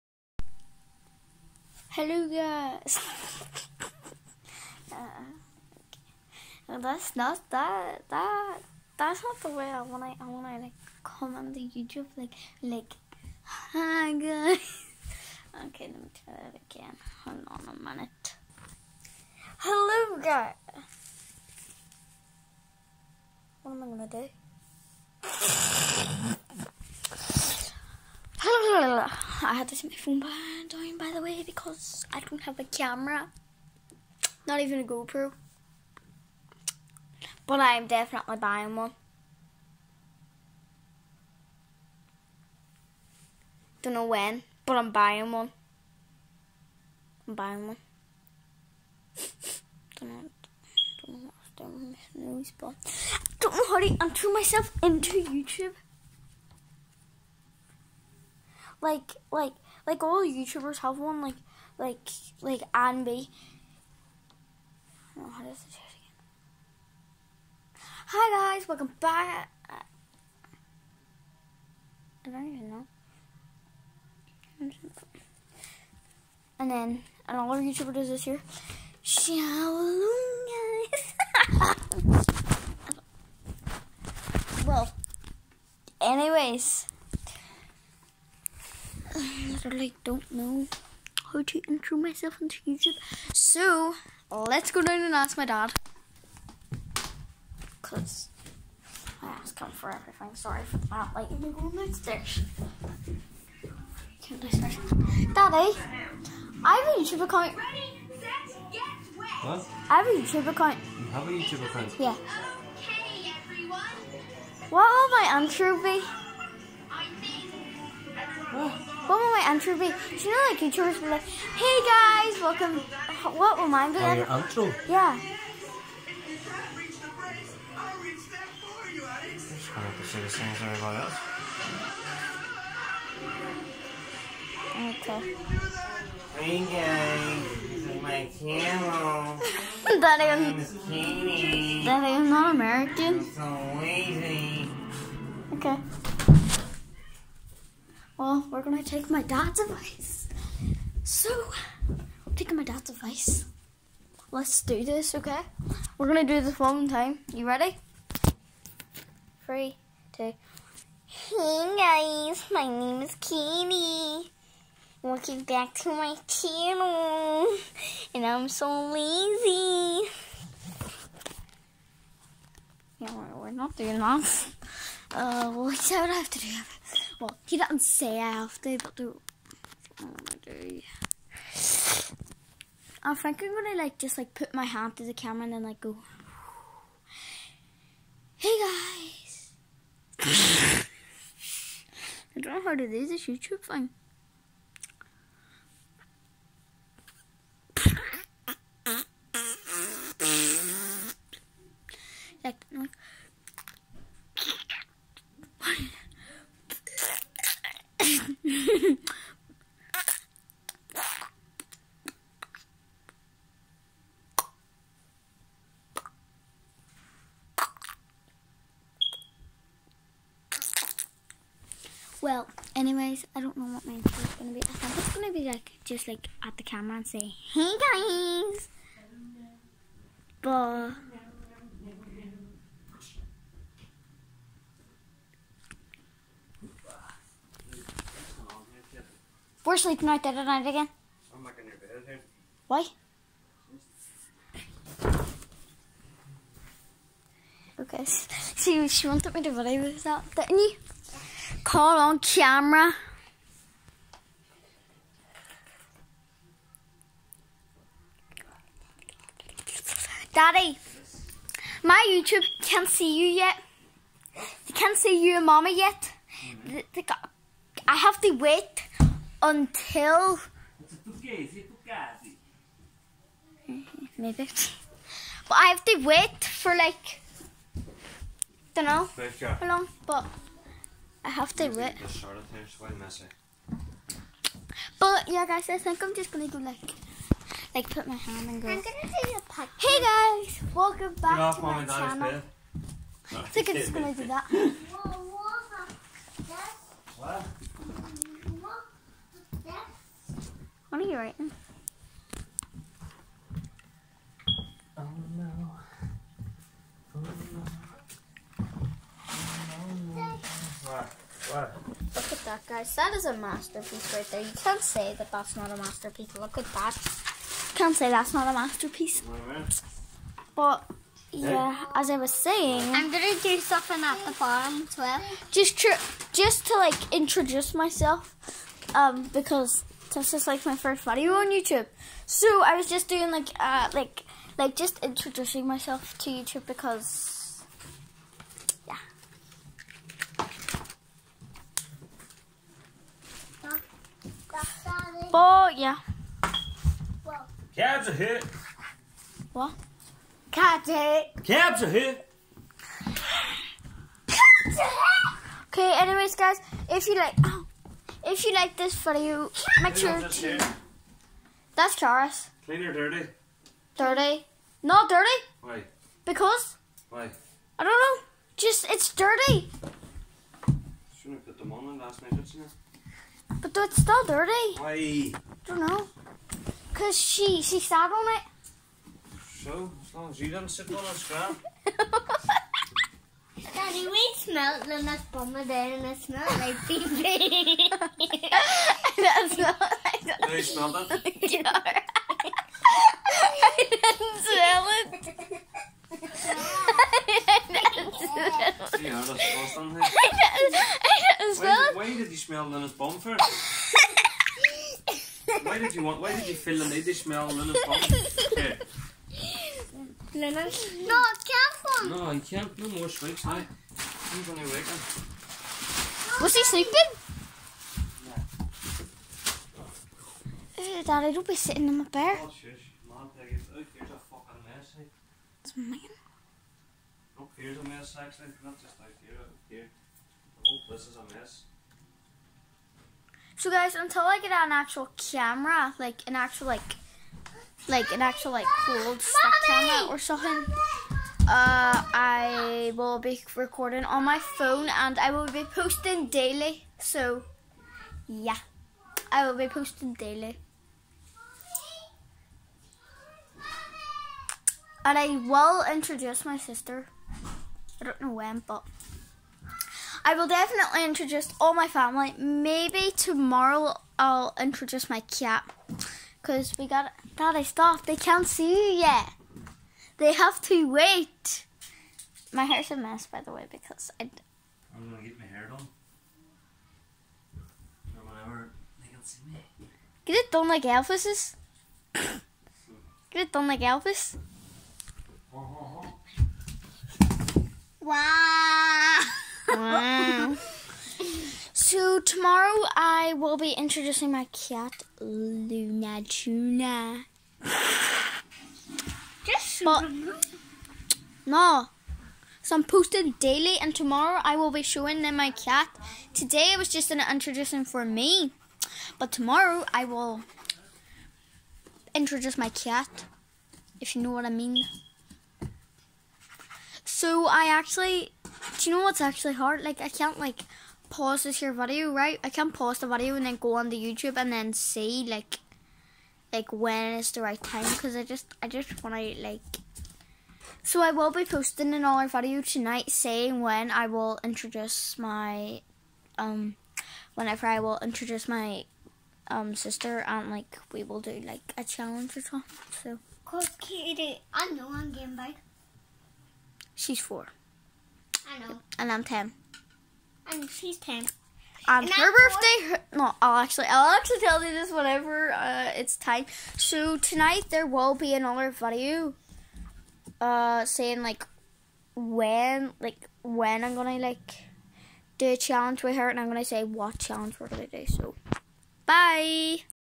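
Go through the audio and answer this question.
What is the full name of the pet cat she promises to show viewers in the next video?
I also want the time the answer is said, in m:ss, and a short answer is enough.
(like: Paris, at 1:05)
Luna Tuna, at 8:15.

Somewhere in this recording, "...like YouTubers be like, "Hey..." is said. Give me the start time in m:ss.
2:00.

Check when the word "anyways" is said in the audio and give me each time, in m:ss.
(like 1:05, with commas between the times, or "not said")
1:26, 3:42, 5:56.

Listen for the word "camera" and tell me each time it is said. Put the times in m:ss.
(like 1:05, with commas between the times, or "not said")
0:32, 3:05, 3:46, 4:12, 7:15, 7:19.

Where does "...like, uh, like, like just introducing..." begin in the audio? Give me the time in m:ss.
5:33.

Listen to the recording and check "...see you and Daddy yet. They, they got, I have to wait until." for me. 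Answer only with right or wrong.
wrong.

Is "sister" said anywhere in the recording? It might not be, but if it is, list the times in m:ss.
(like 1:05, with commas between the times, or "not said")
7:36, 8:59.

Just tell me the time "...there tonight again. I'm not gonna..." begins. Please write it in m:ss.
4:00.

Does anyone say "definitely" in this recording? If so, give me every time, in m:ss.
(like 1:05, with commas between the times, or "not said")
0:37, 7:40.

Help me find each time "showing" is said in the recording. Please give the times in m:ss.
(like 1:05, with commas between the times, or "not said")
8:24.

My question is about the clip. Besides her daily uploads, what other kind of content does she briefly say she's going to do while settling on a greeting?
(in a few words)
A podcast.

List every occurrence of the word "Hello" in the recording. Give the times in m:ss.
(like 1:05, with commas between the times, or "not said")
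0:01, 0:19, 0:28.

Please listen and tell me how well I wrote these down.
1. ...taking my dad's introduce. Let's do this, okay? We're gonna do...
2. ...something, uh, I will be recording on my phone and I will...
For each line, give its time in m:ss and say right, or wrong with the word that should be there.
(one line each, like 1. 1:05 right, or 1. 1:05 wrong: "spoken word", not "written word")
1. 2:32 wrong: "advice", not "introduce"
2. 7:20 right.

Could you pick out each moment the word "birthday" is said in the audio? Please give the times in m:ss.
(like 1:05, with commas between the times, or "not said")
9:12.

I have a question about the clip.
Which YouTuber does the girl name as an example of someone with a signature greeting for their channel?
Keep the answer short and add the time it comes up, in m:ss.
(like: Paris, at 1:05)
Anne B, at 1:02.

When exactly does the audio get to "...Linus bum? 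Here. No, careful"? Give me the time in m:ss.
6:47.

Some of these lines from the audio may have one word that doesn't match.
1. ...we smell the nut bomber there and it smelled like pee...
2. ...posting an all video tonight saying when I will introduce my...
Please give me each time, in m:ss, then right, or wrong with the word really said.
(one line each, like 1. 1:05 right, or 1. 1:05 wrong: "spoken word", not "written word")
1. 6:24 right
2. 8:51 right.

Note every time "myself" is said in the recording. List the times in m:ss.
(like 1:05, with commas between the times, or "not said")
0:54, 1:31, 5:27, 5:35.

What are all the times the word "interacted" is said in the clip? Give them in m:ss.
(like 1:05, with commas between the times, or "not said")
not said.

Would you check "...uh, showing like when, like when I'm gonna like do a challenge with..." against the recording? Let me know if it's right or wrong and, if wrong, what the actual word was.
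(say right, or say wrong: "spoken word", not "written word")
wrong: "saying", not "showing".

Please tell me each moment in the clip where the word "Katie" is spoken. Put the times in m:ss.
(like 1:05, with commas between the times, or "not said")
2:43, 9:03.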